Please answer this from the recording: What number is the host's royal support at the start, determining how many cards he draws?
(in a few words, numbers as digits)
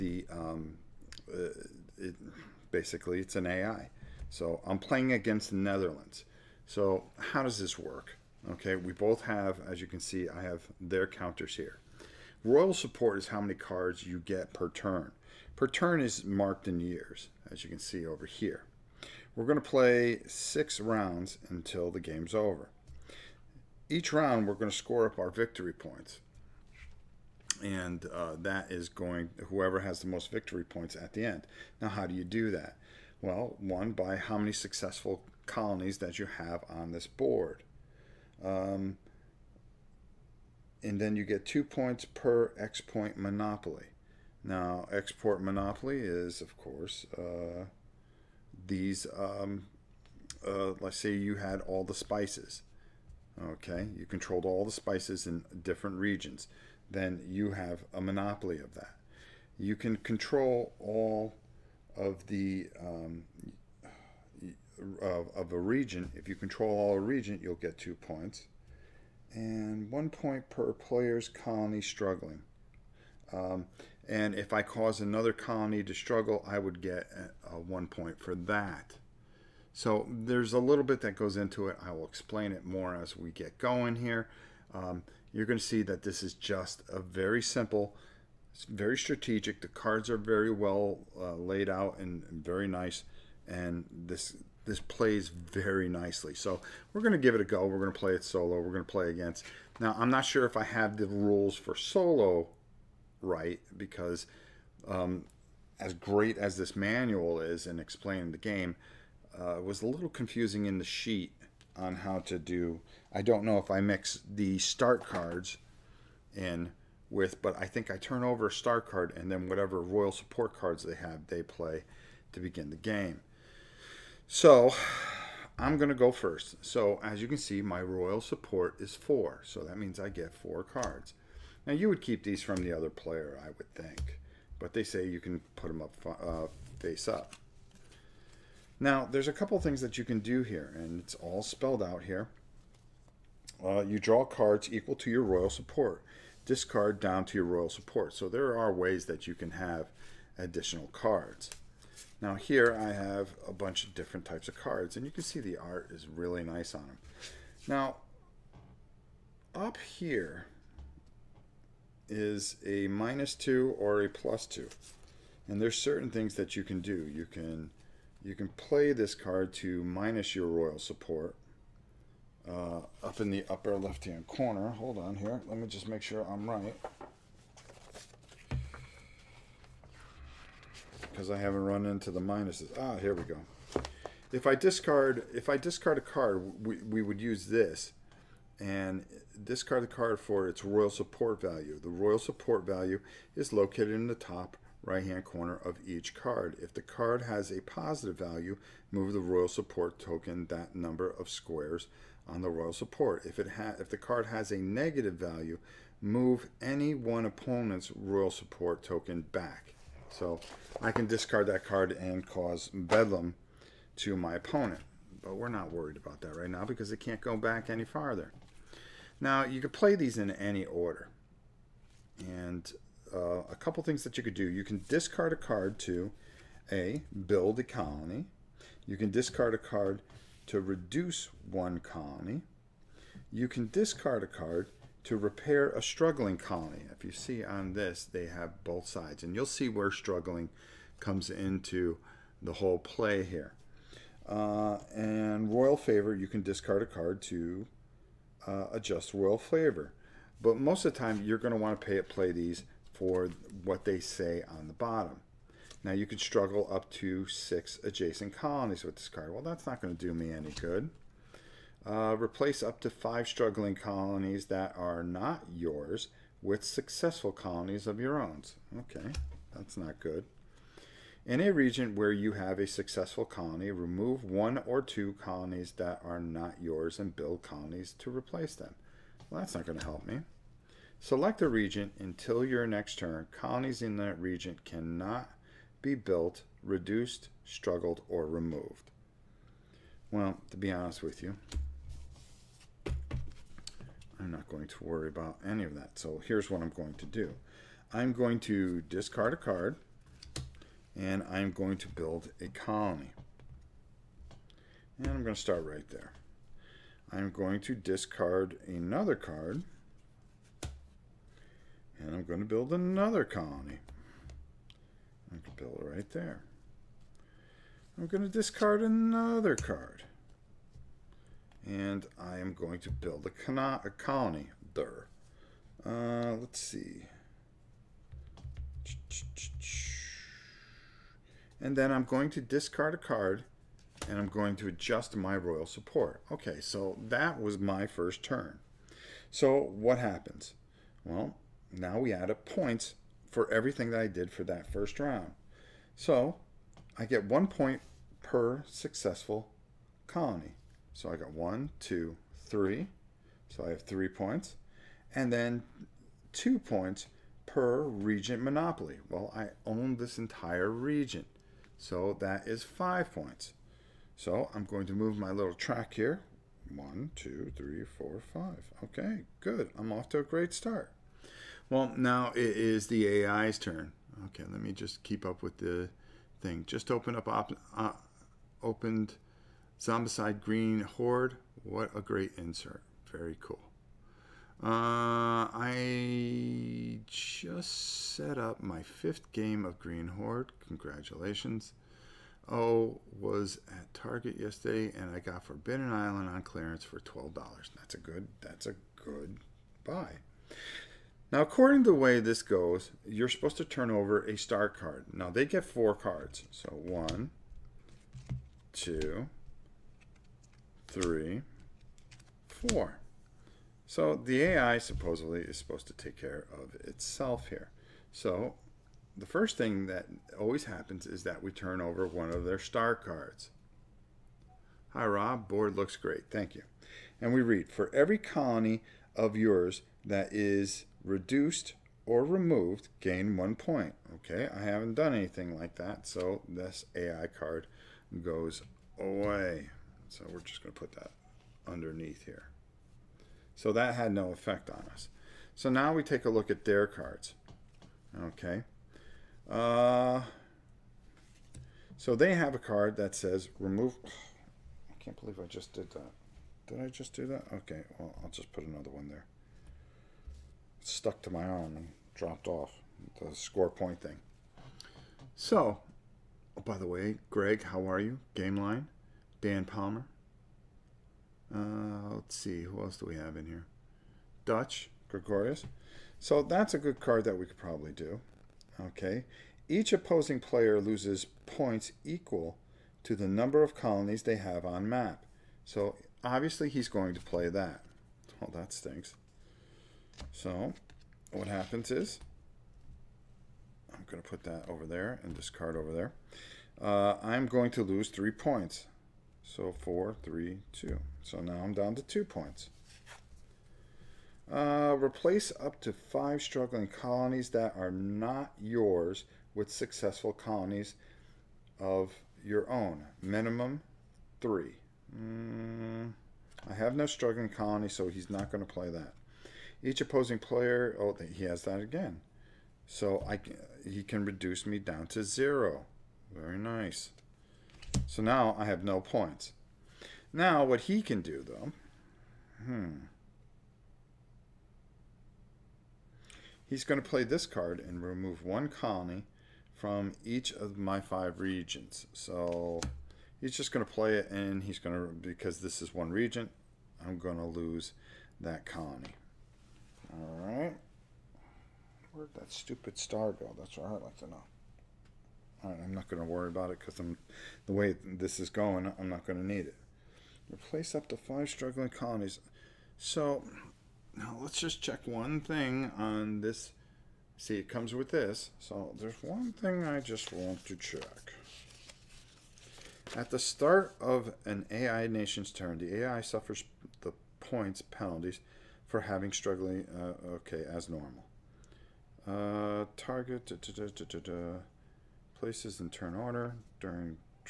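4.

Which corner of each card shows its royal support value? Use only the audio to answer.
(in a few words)
Top right.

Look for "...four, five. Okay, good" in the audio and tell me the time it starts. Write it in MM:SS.
06:07.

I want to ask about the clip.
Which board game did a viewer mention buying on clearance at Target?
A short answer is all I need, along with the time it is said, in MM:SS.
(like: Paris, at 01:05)
Forbidden Island, at 06:35.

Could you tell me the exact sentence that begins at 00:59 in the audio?
You can control all of the um, of, of a region.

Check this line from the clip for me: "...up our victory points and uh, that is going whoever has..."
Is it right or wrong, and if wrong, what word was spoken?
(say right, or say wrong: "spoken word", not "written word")
right.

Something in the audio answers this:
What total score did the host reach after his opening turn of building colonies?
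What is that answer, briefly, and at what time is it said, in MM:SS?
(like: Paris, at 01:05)
5, at 06:02.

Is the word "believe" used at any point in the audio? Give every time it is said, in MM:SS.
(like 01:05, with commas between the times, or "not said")
07:35.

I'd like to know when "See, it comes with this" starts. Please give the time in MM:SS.
09:27.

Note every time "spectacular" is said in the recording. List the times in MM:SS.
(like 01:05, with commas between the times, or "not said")
not said.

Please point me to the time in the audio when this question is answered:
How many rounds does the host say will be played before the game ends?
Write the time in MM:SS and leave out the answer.
00:20.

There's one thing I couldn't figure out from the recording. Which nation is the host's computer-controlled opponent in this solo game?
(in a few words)
The Netherlands.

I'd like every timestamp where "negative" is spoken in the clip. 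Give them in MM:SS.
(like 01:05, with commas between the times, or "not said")
03:24.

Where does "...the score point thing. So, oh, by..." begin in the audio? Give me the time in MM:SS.
07:43.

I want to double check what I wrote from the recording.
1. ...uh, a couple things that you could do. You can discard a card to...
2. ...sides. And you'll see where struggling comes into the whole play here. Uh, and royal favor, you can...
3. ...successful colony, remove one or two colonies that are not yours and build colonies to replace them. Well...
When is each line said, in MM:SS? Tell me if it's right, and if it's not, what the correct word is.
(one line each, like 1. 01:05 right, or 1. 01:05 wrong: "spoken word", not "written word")
1. 03:43 right
2. 03:58 right
3. 04:32 right.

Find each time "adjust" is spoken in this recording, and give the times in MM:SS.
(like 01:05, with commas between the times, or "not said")
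04:08, 05:34.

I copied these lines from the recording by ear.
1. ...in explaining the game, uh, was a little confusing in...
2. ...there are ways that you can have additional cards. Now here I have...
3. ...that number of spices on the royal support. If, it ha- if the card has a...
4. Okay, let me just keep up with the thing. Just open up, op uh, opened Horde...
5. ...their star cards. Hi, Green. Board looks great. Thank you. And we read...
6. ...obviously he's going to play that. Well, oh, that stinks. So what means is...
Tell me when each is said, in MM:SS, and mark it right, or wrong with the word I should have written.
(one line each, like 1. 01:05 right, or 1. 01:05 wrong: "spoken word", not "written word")
1. 01:47 right
2. 02:28 right
3. 03:20 wrong: "squares", not "spices"
4. 06:14 wrong: "Zombicide", not "Horde"
5. 07:02 wrong: "Rob", not "Green"
6. 08:06 wrong: "happens", not "means".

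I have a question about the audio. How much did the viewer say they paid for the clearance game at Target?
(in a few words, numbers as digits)
$12.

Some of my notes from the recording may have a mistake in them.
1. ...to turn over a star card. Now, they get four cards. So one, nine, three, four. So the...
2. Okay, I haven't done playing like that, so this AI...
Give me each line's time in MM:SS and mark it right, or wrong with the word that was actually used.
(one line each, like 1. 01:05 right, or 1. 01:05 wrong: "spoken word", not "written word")
1. 06:43 wrong: "two", not "nine"
2. 07:14 wrong: "anything", not "playing".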